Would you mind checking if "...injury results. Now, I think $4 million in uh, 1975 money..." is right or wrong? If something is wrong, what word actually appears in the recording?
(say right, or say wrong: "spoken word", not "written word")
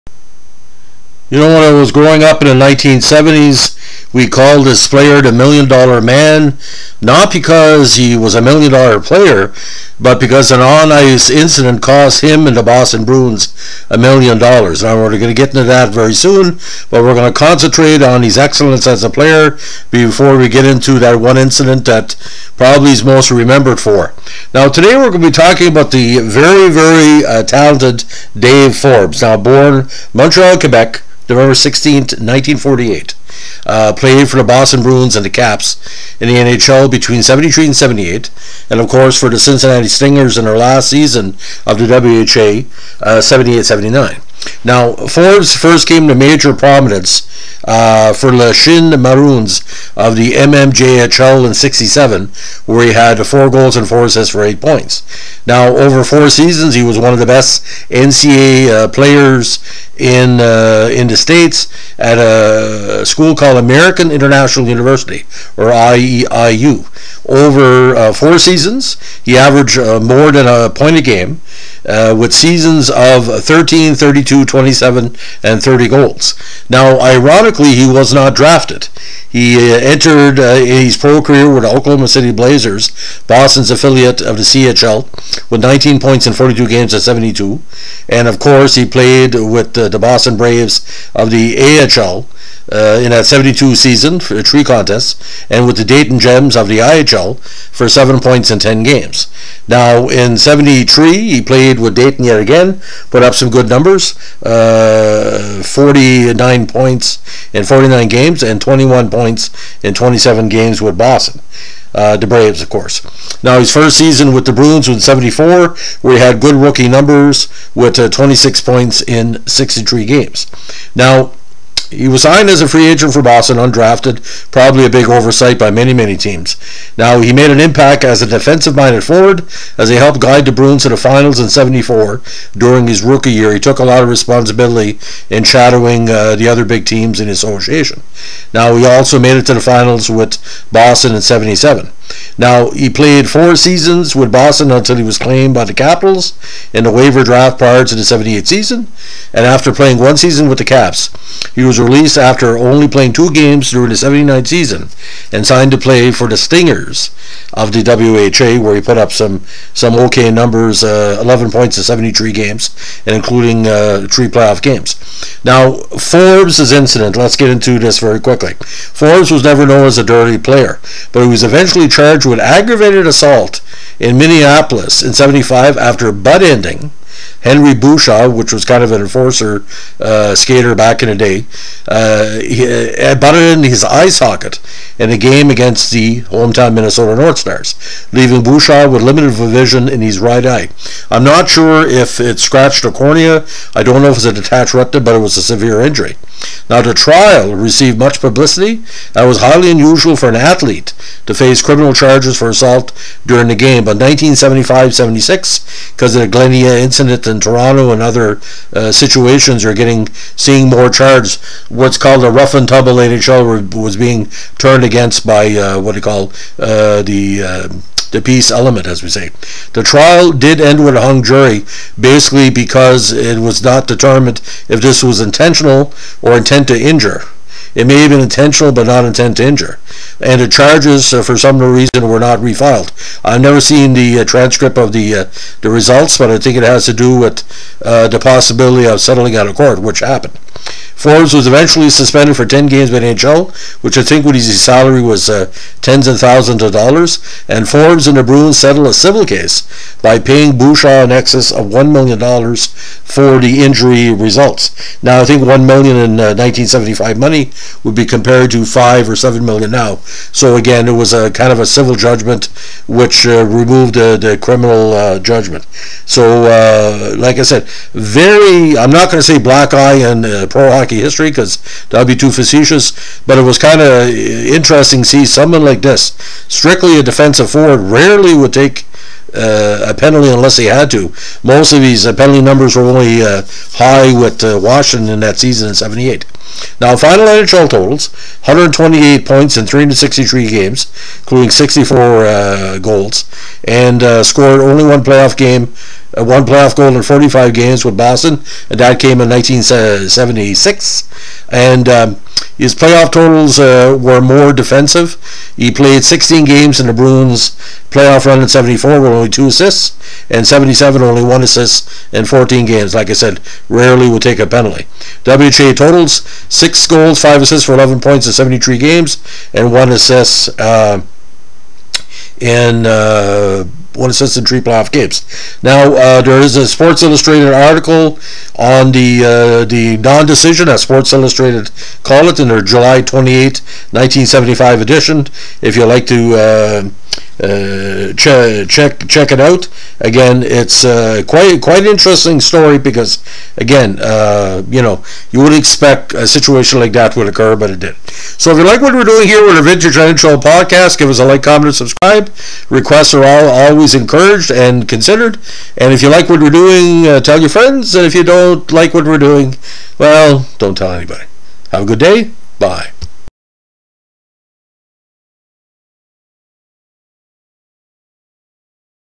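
wrong: "1", not "4".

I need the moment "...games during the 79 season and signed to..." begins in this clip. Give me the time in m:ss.
2:33.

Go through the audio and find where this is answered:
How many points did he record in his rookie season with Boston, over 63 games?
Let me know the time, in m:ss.
1:58.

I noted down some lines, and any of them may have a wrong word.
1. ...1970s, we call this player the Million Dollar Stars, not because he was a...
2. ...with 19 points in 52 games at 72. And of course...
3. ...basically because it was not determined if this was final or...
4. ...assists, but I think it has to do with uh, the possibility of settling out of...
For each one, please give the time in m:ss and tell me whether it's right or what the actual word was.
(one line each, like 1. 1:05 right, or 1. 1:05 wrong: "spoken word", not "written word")
1. 0:02 wrong: "Man", not "Stars"
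2. 1:25 wrong: "42", not "52"
3. 3:41 wrong: "intentional", not "final"
4. 3:55 wrong: "results", not "assists".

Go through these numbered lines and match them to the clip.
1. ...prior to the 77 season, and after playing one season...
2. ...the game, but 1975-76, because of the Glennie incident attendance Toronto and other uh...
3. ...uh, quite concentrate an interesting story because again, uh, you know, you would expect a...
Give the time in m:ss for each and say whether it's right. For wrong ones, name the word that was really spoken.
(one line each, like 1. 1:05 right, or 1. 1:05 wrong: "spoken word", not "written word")
1. 2:27 wrong: "78", not "77"
2. 3:23 right
3. 5:40 wrong: "quite", not "concentrate".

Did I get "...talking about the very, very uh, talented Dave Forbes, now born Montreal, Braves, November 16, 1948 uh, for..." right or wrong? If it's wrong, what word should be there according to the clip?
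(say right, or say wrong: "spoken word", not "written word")
wrong: "Quebec", not "Braves".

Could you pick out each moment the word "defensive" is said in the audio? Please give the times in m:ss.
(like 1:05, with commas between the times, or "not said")
2:08, 4:37, 5:04.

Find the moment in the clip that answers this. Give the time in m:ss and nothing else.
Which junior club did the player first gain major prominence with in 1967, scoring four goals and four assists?
0:48.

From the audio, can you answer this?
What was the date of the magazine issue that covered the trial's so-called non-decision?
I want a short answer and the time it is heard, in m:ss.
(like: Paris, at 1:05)
July 28, 1975, at 5:32.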